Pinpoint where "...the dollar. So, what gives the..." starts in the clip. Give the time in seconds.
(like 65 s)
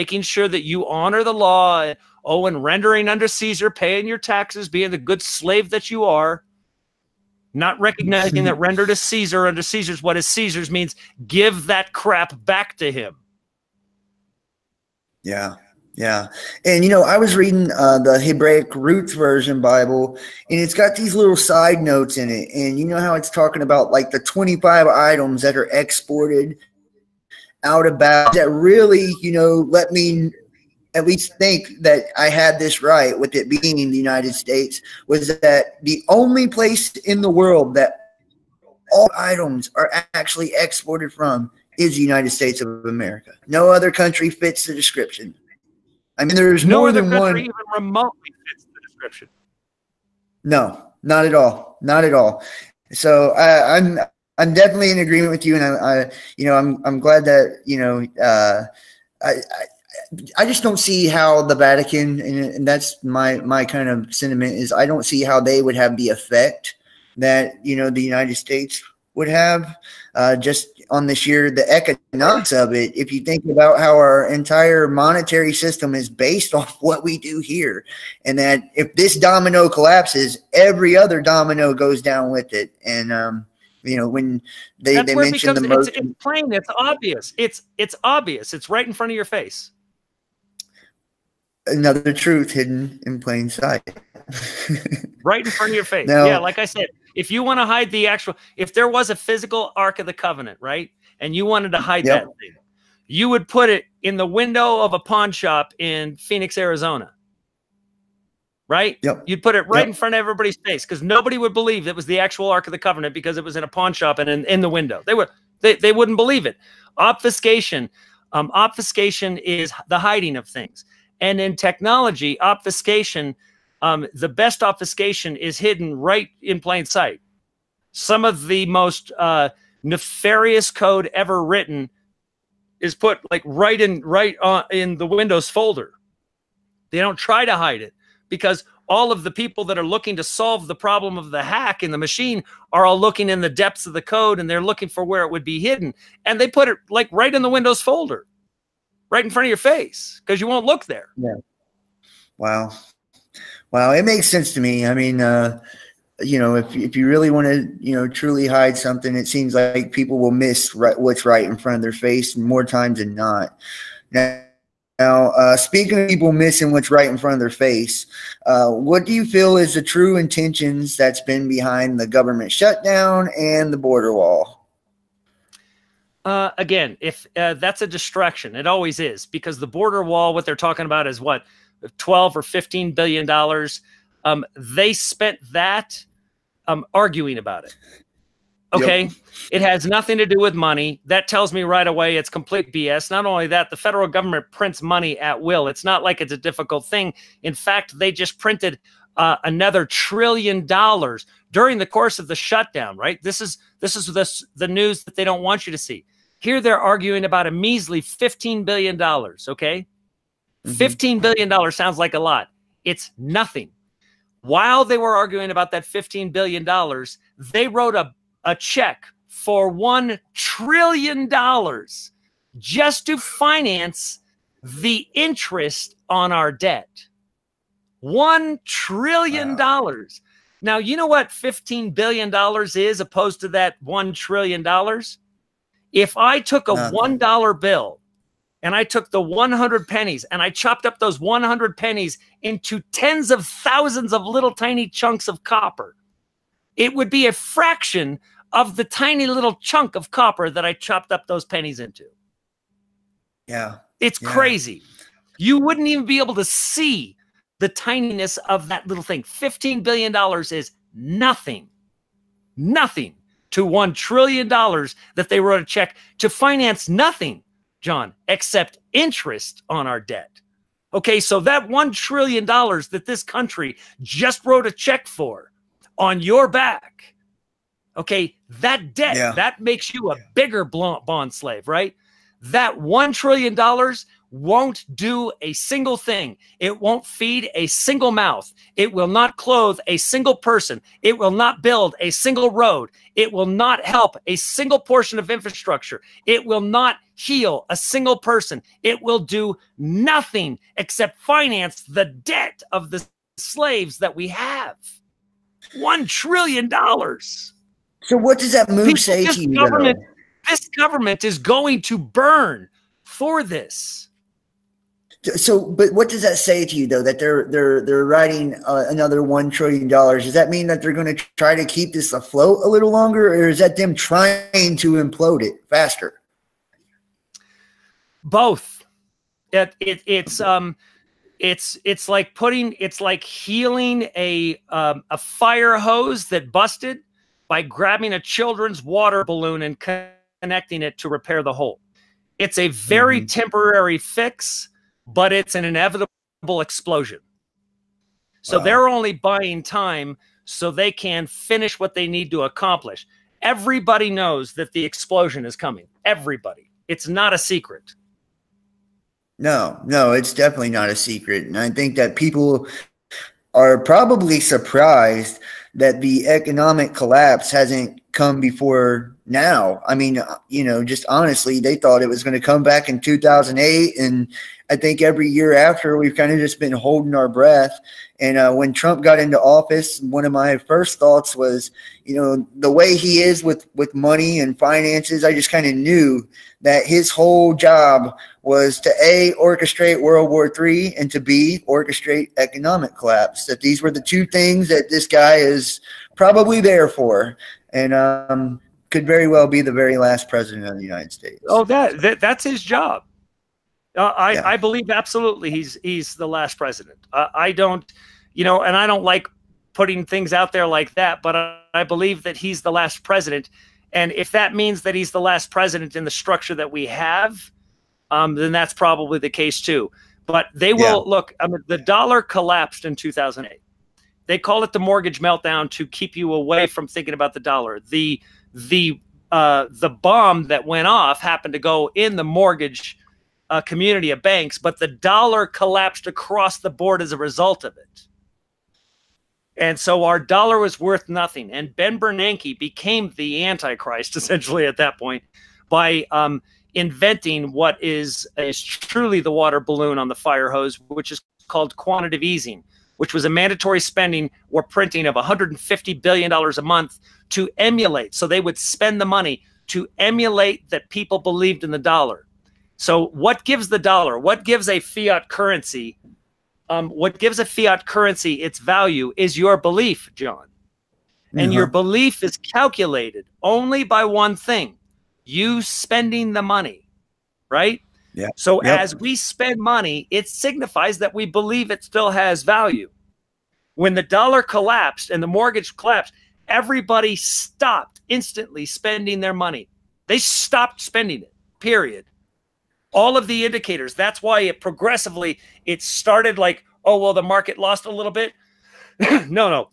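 461 s.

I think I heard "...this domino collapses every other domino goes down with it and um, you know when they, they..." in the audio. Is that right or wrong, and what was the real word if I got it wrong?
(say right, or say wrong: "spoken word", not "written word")
right.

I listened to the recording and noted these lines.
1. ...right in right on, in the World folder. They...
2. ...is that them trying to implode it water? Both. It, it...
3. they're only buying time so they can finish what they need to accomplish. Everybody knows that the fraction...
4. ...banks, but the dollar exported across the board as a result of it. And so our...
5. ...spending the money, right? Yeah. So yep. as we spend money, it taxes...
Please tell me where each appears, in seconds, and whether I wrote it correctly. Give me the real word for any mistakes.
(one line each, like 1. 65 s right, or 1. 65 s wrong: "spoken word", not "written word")
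1. 133 s wrong: "Windows", not "World"
2. 323 s wrong: "faster", not "water"
3. 348 s wrong: "explosion", not "fraction"
4. 434 s wrong: "collapsed", not "exported"
5. 475 s wrong: "signifies", not "taxes".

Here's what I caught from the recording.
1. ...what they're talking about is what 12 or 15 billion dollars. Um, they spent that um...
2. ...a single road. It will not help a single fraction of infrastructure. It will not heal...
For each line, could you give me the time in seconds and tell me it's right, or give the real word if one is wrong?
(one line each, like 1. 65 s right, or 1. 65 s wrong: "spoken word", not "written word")
1. 180 s right
2. 291 s wrong: "portion", not "fraction".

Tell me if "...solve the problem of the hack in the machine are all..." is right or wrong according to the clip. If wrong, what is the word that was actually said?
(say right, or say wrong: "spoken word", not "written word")
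right.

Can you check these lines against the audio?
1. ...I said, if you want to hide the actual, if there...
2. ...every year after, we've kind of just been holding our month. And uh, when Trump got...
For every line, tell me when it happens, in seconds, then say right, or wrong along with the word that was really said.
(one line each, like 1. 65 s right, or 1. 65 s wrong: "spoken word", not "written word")
1. 96 s right
2. 375 s wrong: "breath", not "month".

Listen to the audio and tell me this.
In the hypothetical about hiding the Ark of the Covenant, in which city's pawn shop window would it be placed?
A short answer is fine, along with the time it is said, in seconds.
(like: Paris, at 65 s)
Phoenix, Arizona, at 106 s.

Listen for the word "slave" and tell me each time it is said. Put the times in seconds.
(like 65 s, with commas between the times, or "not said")
5 s, 281 s, 303 s.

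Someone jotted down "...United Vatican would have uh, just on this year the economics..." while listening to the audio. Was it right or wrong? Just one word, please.
wrong.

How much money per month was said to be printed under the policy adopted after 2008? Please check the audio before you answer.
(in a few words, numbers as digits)
$150 billion.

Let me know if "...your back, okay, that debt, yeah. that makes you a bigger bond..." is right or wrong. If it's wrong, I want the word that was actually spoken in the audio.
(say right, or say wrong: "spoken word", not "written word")
right.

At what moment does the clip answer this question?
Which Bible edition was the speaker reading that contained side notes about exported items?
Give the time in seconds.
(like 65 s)
18 s.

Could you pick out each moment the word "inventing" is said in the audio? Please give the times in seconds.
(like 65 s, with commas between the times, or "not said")
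446 s.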